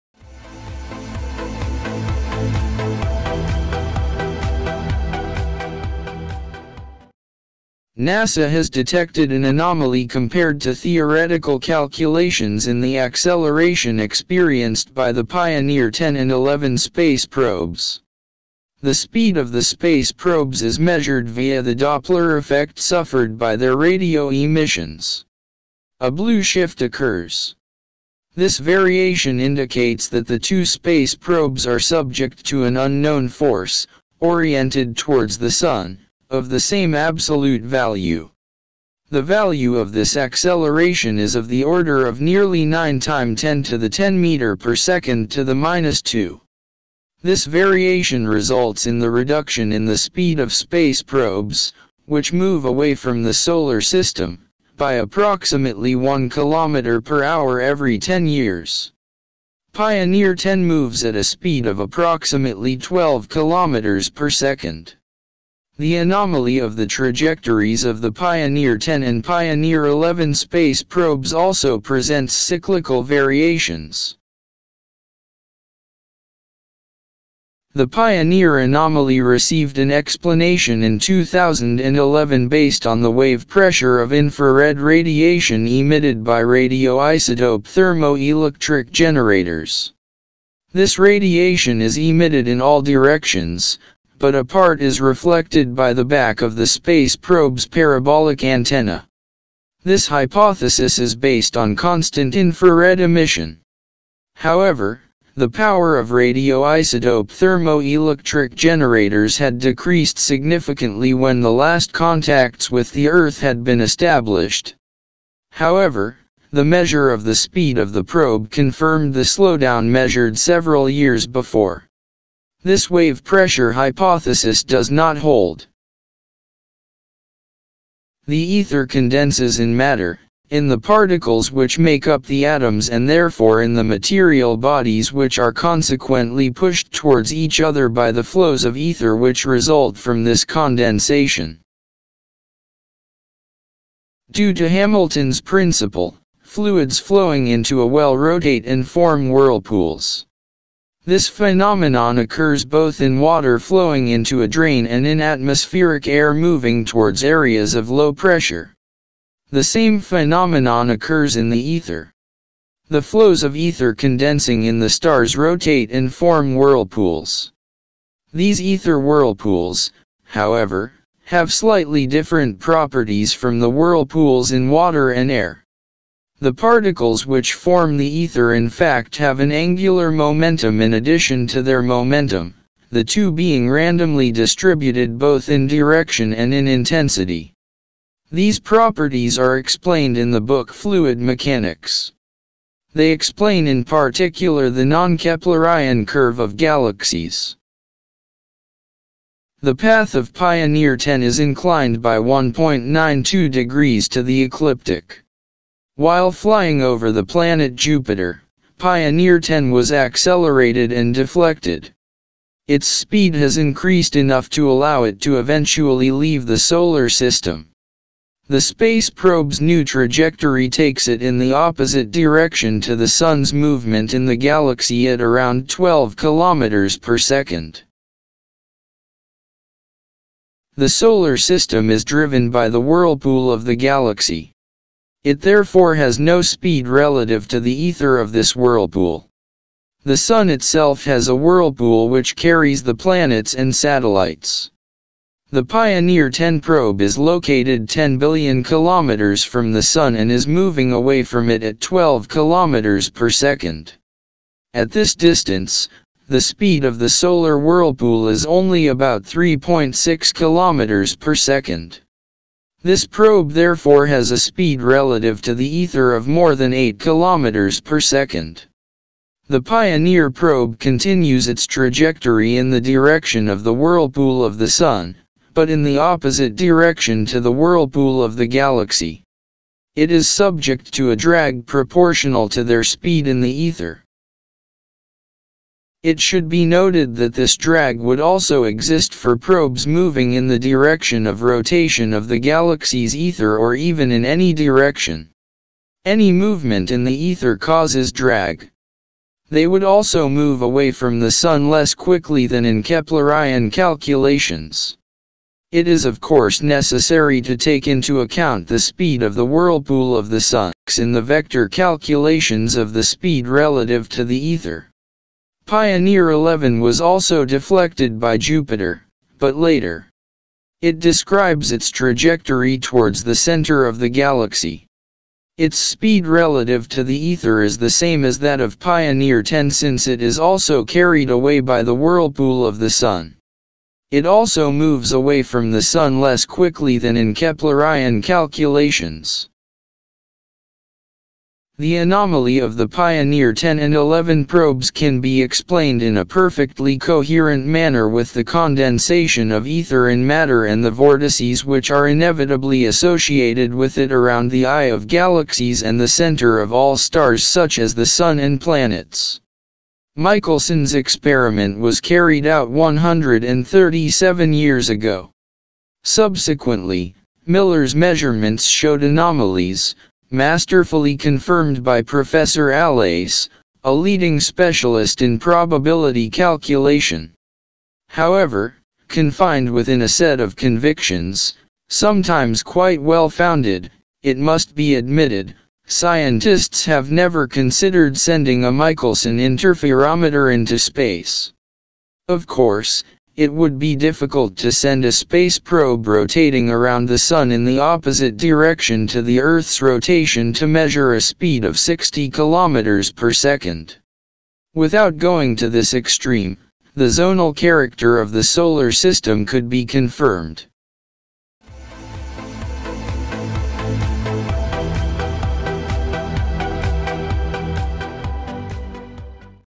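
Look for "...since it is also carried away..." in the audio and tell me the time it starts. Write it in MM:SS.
05:29.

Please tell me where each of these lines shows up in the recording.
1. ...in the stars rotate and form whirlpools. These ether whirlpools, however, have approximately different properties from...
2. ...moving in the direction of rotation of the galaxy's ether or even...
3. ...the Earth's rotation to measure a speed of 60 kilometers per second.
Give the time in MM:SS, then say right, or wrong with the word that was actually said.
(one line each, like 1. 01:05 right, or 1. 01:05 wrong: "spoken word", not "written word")
1. 02:44 wrong: "slightly", not "approximately"
2. 04:49 right
3. 06:39 right.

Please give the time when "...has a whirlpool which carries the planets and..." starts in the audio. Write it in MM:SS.
04:01.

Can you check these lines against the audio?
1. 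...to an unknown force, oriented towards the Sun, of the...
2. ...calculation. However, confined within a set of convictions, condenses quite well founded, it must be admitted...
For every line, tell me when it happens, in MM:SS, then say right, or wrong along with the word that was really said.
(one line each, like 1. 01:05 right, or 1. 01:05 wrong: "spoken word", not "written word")
1. 00:32 right
2. 06:16 wrong: "sometimes", not "condenses".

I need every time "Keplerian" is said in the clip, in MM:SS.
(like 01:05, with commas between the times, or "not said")
03:14, 05:02, 05:37.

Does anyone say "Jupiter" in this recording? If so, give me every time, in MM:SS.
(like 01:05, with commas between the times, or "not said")
03:27, 05:18.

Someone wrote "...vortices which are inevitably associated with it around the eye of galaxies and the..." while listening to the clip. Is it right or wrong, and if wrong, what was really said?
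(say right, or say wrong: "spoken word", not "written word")
right.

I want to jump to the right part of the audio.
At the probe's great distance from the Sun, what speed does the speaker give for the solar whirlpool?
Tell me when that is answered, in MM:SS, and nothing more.
04:19.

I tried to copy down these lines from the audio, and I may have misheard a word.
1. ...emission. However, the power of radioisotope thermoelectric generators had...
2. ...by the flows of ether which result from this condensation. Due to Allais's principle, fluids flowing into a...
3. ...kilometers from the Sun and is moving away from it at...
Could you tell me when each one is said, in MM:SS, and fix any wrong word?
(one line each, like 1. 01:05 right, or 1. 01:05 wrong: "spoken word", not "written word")
1. 01:42 right
2. 02:17 wrong: "Hamilton", not "Allais"
3. 04:08 right.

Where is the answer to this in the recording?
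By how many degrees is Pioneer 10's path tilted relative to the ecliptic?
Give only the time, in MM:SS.
03:22.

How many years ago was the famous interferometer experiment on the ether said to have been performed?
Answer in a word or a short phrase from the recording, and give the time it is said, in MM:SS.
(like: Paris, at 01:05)
137, at 06:02.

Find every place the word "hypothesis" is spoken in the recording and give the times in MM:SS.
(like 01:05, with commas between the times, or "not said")
01:40, 02:03.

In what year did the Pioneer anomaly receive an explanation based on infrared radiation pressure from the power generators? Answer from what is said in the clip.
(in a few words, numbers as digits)
2011.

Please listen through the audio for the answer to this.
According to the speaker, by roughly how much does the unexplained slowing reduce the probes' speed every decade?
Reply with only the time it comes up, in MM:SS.
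00:55.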